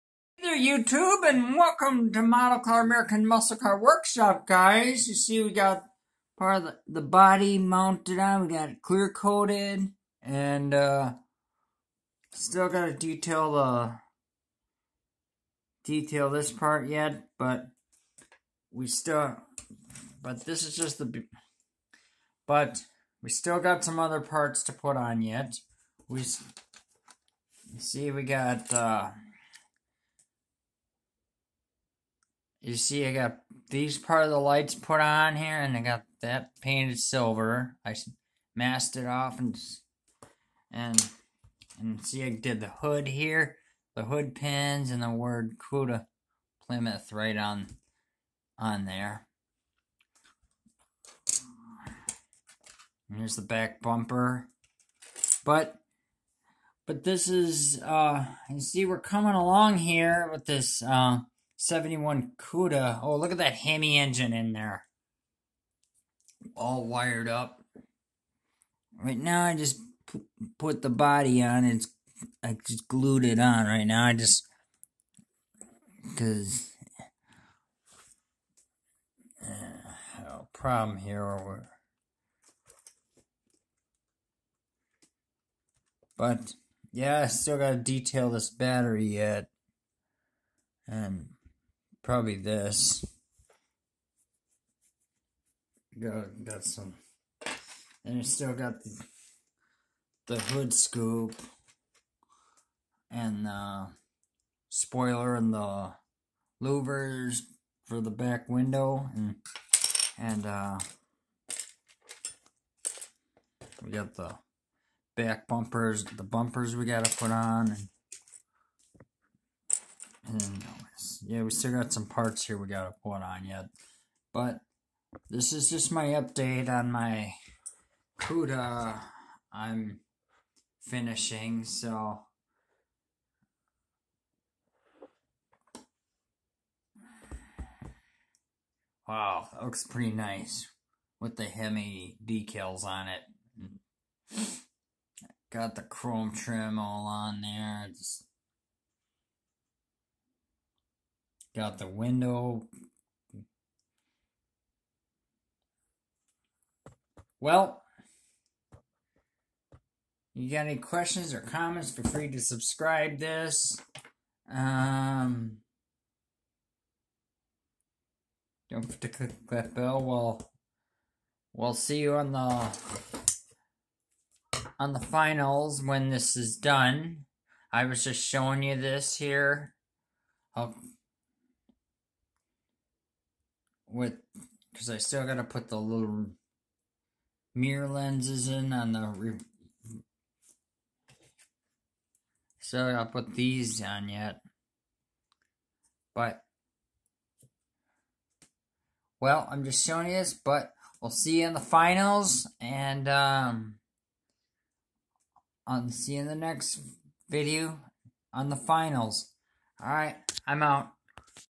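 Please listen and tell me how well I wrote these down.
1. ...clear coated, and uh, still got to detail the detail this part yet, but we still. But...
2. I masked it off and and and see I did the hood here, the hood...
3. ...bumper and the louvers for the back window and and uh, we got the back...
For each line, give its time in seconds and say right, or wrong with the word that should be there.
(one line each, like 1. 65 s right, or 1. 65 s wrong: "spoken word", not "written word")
1. 8 s right
2. 37 s right
3. 104 s wrong: "spoiler", not "bumper".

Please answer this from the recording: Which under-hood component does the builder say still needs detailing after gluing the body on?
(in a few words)
battery.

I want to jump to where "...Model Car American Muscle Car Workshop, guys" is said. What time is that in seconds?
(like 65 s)
2 s.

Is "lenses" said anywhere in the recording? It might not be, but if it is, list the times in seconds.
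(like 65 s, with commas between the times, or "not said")
187 s.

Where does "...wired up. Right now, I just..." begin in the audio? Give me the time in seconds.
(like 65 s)
66 s.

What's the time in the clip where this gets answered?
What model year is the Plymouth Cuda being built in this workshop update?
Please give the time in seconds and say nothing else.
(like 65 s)
61 s.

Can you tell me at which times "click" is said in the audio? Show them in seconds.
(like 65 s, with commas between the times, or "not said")
169 s.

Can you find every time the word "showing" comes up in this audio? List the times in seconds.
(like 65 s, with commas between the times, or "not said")
178 s, 199 s.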